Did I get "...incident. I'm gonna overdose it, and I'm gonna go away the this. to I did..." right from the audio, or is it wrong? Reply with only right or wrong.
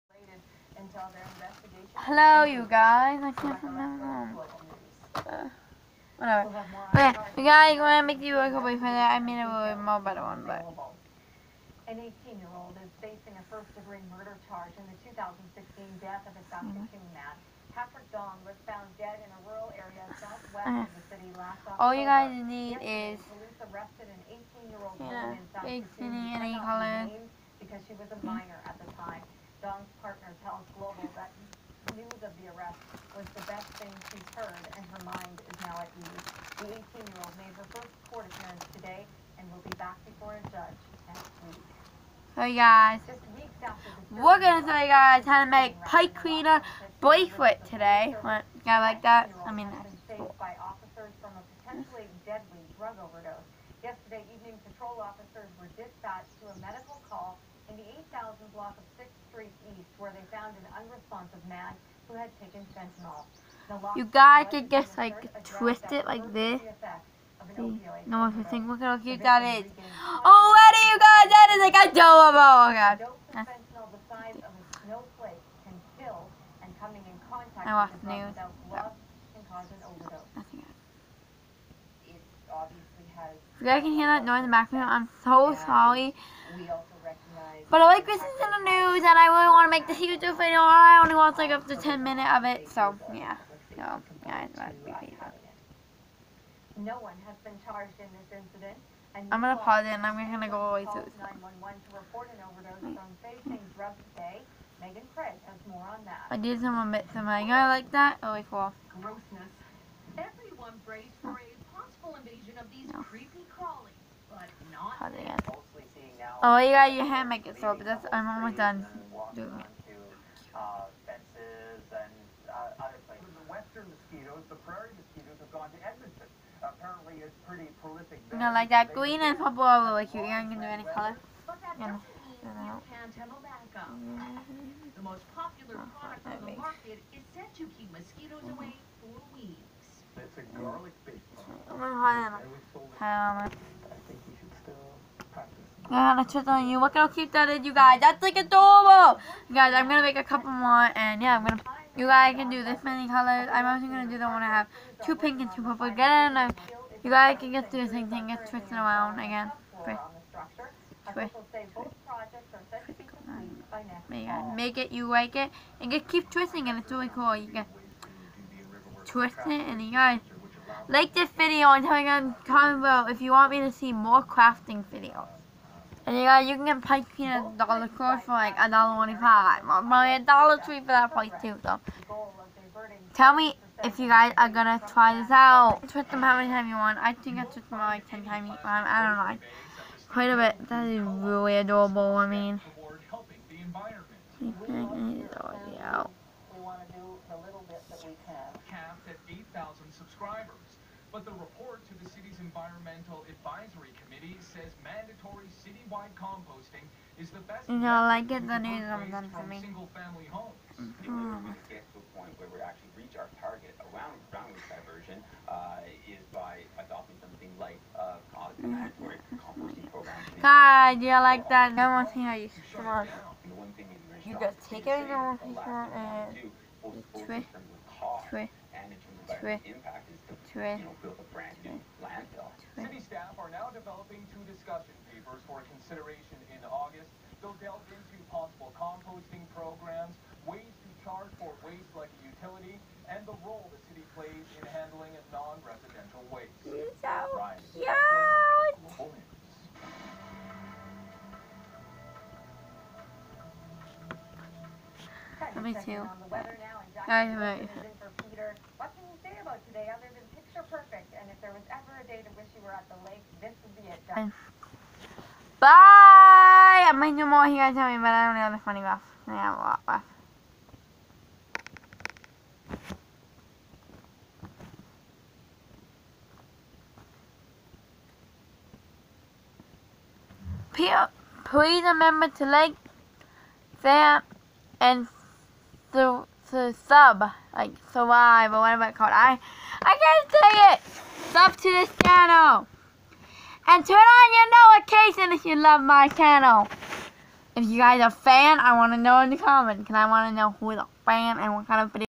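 wrong.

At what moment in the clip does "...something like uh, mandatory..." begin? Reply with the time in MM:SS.
03:37.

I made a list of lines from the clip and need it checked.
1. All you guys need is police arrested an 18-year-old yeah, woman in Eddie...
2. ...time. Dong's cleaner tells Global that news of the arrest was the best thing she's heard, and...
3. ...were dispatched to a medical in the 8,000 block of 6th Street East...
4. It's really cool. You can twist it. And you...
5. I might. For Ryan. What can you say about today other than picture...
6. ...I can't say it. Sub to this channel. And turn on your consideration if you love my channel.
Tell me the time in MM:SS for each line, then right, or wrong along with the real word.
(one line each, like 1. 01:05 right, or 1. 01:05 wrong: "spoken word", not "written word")
1. 00:21 wrong: "South", not "Eddie"
2. 00:28 wrong: "partner", not "cleaner"
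3. 00:55 right
4. 02:46 right
5. 04:17 wrong: "Peter", not "Ryan"
6. 04:49 wrong: "notification", not "consideration".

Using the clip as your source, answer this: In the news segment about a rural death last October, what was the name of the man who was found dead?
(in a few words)
Patrick Dong.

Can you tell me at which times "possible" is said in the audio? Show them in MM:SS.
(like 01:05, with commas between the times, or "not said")
01:51, 03:58.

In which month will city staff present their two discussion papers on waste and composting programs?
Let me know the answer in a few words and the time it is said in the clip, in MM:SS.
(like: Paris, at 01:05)
August, at 03:56.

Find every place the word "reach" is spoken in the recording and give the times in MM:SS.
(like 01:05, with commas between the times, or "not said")
03:32.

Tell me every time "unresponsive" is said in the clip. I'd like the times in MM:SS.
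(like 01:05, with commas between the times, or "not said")
01:00.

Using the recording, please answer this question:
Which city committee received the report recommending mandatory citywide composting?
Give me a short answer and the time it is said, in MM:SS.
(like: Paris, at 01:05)
Environmental Advisory Committee, at 03:22.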